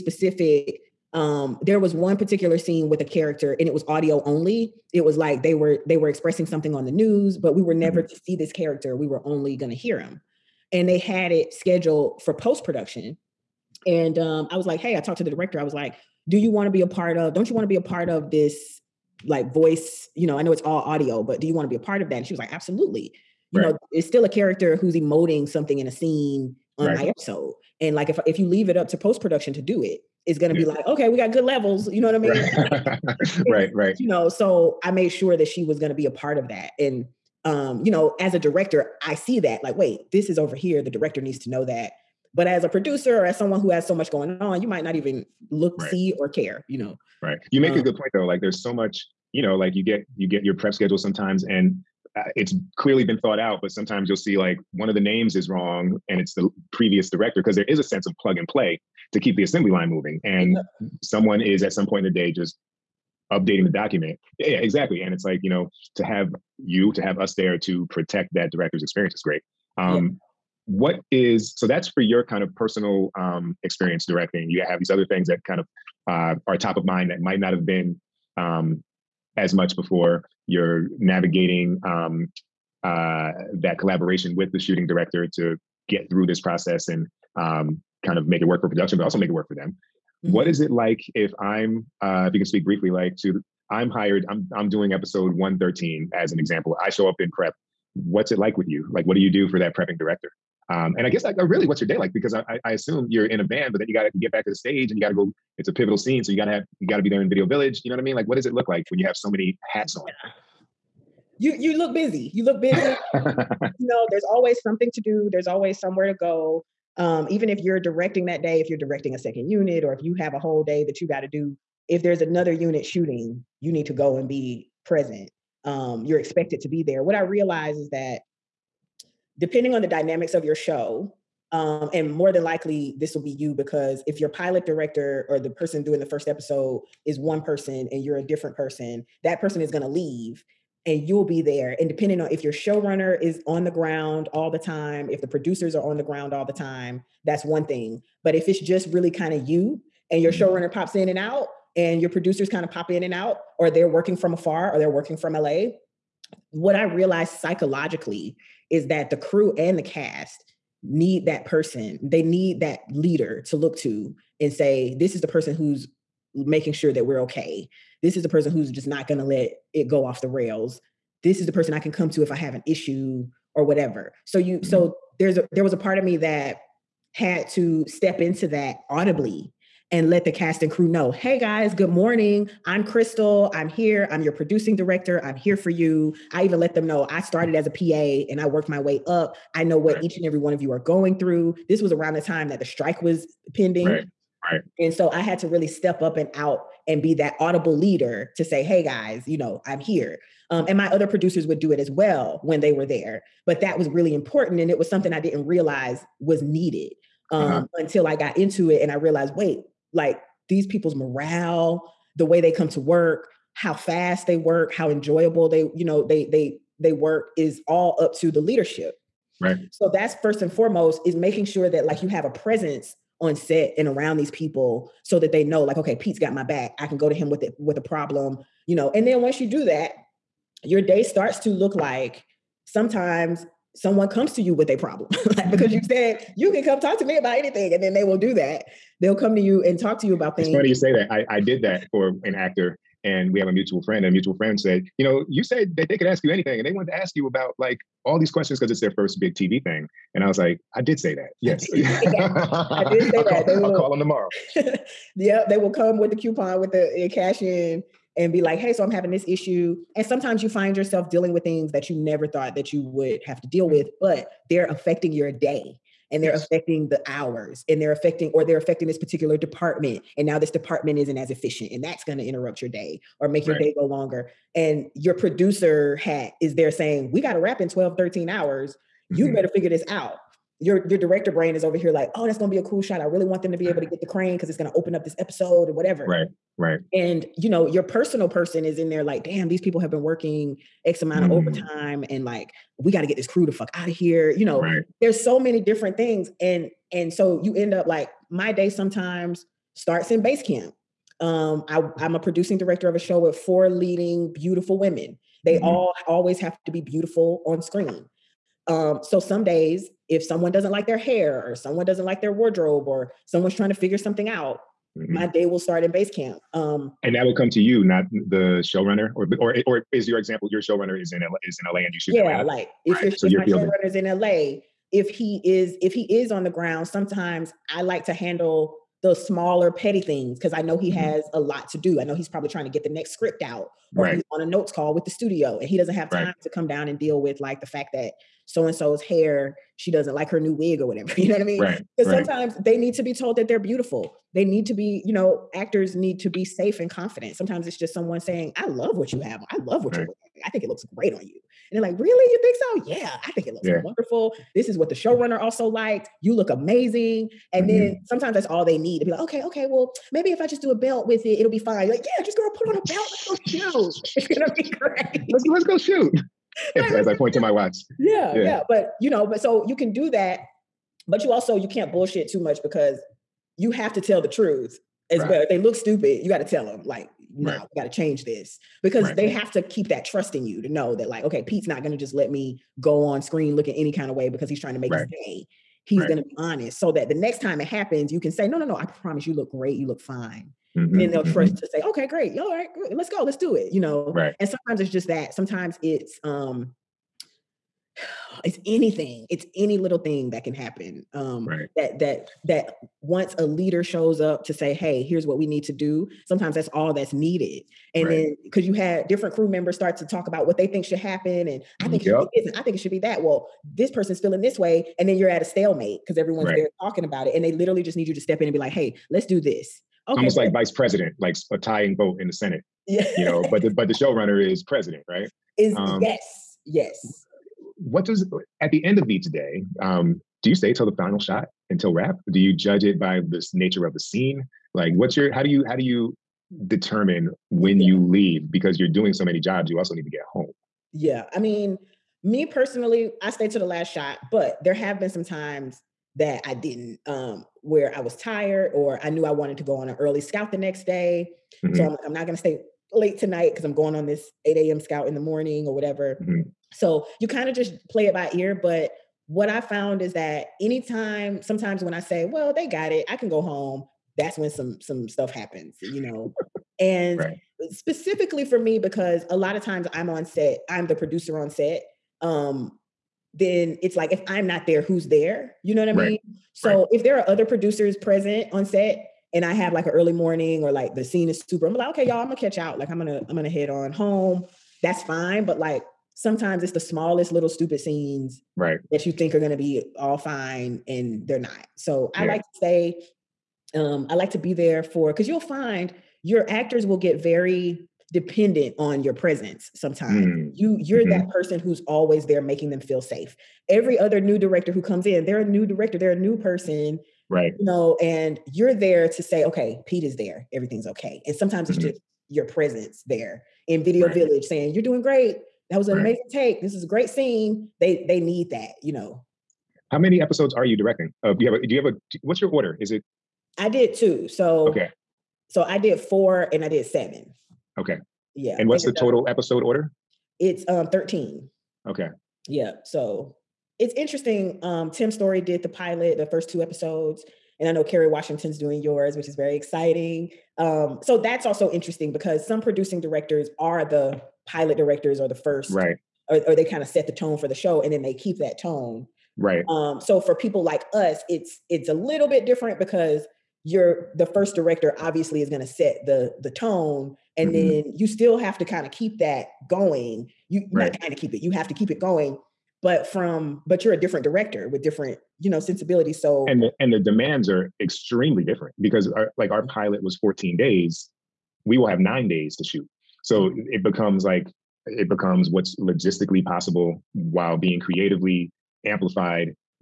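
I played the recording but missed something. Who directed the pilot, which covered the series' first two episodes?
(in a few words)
Tim Story.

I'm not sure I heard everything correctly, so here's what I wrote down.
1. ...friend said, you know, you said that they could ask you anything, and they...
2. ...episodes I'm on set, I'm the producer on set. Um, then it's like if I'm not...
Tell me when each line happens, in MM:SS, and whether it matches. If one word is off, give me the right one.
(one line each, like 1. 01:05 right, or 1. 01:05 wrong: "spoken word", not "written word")
1. 04:04 right
2. 07:49 wrong: "times", not "episodes".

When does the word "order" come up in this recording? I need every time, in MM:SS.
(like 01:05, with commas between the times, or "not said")
08:42, 08:49.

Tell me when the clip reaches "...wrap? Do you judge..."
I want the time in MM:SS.
07:11.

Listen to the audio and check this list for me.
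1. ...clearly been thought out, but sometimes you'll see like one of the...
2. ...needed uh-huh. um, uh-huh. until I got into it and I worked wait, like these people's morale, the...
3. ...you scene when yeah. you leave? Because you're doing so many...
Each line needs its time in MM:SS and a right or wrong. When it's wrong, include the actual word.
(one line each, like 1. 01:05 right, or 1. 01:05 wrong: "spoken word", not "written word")
1. 00:52 right
2. 03:26 wrong: "realized", not "worked"
3. 07:15 wrong: "determine", not "scene".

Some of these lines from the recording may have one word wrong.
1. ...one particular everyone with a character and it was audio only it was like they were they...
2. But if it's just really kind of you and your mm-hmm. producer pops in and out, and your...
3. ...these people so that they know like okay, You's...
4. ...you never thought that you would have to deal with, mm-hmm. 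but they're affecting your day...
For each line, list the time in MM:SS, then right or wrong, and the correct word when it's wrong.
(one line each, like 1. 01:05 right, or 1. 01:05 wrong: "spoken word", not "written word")
1. 00:01 wrong: "scene", not "everyone"
2. 02:28 wrong: "showrunner", not "producer"
3. 03:44 wrong: "Pete", not "You"
4. 04:21 right.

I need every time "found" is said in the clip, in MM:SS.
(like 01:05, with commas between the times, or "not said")
07:39.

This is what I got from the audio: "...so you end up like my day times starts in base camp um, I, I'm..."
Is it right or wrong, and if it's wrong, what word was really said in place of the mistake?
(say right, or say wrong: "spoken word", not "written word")
wrong: "sometimes", not "times".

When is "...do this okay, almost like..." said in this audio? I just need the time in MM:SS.
06:59.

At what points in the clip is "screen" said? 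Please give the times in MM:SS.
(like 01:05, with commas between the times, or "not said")
05:07, 06:23.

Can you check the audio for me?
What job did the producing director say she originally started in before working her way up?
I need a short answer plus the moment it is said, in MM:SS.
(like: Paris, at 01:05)
PA, at 03:07.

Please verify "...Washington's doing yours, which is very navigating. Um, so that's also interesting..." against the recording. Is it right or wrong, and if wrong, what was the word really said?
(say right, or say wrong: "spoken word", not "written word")
wrong: "exciting", not "navigating".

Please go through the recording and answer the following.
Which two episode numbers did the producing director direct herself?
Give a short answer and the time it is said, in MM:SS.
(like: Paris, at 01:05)
4 and 7, at 08:45.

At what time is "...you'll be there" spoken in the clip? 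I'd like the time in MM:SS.
02:21.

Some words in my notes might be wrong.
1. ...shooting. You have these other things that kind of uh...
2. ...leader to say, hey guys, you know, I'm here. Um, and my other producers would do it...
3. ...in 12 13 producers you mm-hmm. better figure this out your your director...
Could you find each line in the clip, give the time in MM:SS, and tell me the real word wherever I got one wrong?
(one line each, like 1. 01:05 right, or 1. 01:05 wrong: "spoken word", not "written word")
1. 01:14 wrong: "directing", not "shooting"
2. 03:17 right
3. 04:37 wrong: "hours", not "producers".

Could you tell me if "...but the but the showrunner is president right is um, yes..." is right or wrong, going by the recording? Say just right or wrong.
right.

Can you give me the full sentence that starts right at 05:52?
Yeah, I think it looks yeah.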